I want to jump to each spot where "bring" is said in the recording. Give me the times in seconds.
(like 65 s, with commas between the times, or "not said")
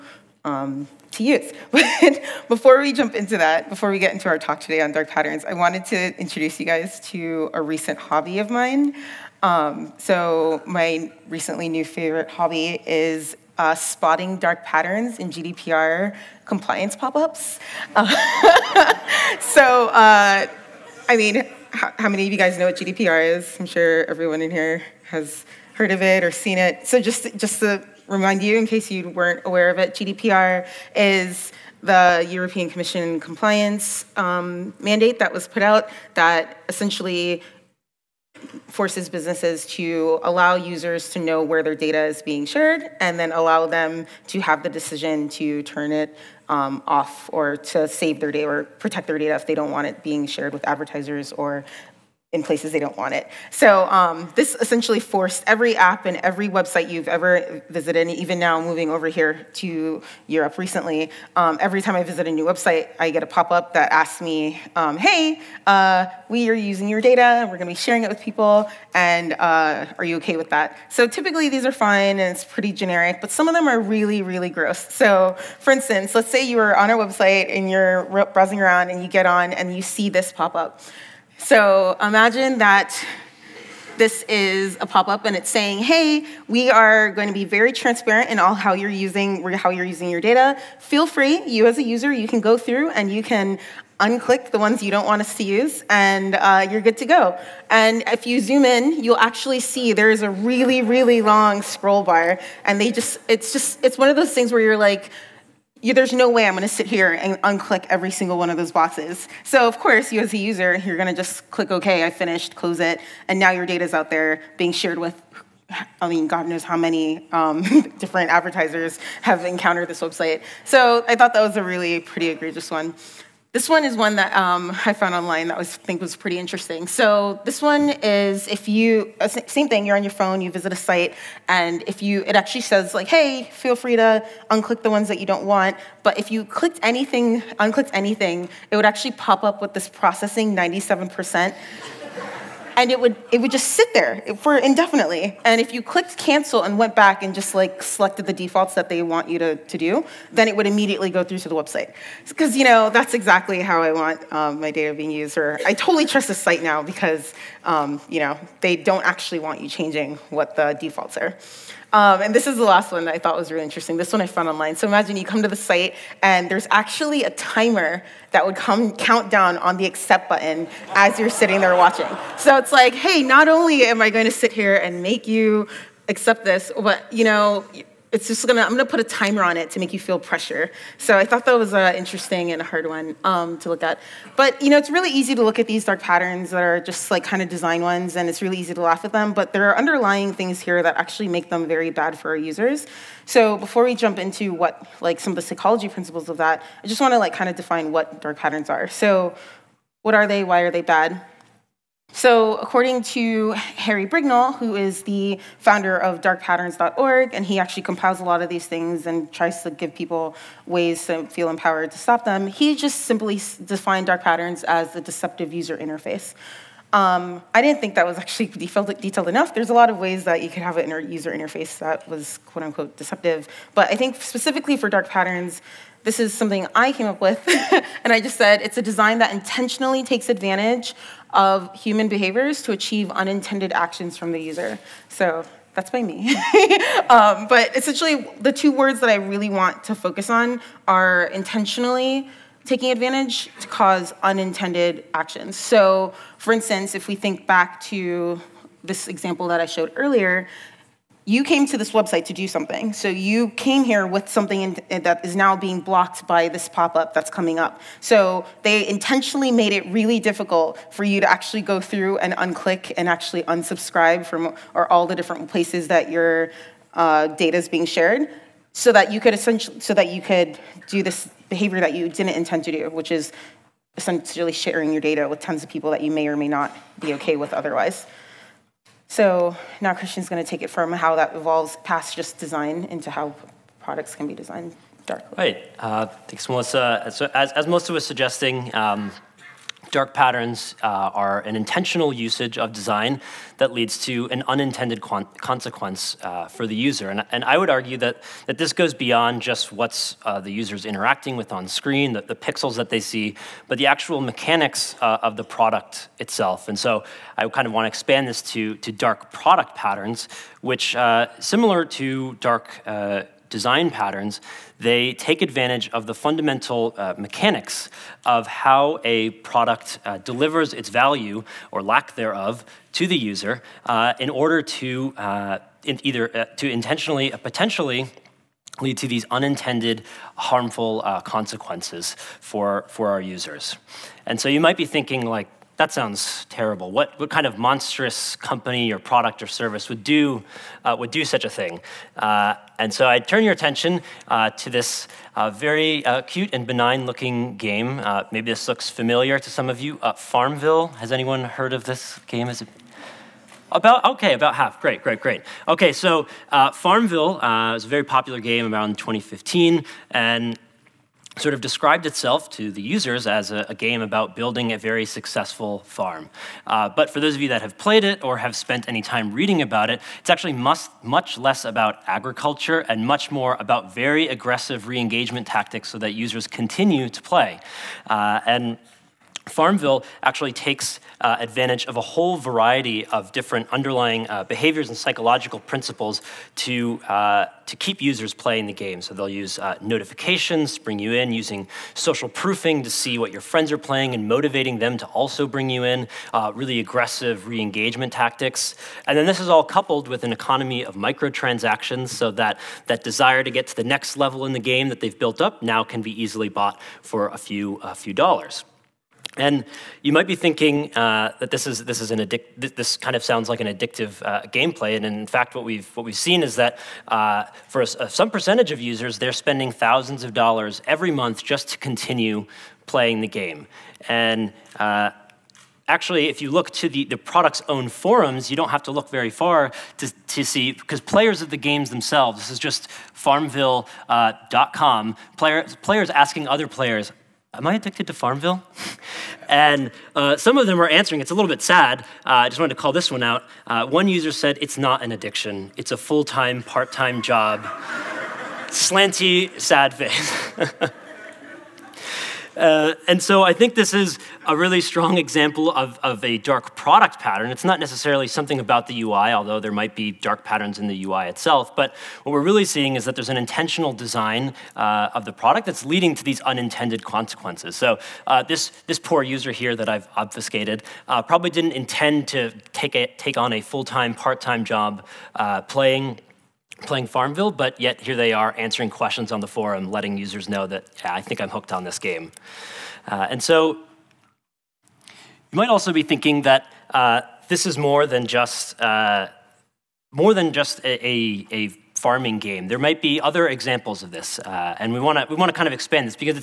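390 s, 395 s.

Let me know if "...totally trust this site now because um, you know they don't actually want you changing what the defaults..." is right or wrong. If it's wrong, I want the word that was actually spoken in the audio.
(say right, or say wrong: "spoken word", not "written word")
right.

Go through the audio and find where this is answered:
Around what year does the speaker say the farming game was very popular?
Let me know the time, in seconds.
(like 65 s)
358 s.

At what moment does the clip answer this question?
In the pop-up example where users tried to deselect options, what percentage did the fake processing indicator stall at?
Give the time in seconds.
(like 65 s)
140 s.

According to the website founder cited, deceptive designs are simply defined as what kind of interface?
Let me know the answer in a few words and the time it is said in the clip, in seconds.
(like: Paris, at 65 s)
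Deceptive user interface, at 214 s.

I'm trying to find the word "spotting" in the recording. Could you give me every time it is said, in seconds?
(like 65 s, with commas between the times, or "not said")
13 s.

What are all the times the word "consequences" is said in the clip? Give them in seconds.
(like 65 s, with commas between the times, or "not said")
294 s, 331 s, 467 s.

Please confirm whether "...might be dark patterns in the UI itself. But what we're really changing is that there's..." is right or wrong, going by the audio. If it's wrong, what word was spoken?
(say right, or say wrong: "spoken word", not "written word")
wrong: "seeing", not "changing".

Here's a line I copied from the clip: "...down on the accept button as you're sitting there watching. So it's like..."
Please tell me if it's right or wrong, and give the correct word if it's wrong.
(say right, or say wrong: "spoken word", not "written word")
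right.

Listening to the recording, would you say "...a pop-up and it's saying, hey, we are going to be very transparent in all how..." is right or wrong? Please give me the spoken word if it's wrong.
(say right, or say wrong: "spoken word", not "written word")
right.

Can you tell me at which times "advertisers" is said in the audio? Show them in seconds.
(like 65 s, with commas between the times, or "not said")
50 s, 118 s.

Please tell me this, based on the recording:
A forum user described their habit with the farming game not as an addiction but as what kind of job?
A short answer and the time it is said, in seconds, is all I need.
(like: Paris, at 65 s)
Full time, part time job, at 445 s.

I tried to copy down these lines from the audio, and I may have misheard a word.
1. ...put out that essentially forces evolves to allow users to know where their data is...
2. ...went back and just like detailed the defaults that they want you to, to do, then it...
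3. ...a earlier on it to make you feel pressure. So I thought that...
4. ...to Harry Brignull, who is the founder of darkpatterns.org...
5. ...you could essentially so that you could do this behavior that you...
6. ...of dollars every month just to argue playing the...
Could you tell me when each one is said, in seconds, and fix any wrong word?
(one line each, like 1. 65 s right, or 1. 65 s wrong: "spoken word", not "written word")
1. 35 s wrong: "businesses", not "evolves"
2. 146 s wrong: "selected", not "detailed"
3. 178 s wrong: "timer", not "earlier"
4. 203 s right
5. 269 s right
6. 420 s wrong: "continue", not "argue".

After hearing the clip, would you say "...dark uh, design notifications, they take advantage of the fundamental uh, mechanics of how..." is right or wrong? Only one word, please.
wrong.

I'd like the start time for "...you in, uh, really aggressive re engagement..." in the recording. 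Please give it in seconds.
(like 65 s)
395 s.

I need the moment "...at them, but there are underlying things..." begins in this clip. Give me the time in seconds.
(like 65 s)
189 s.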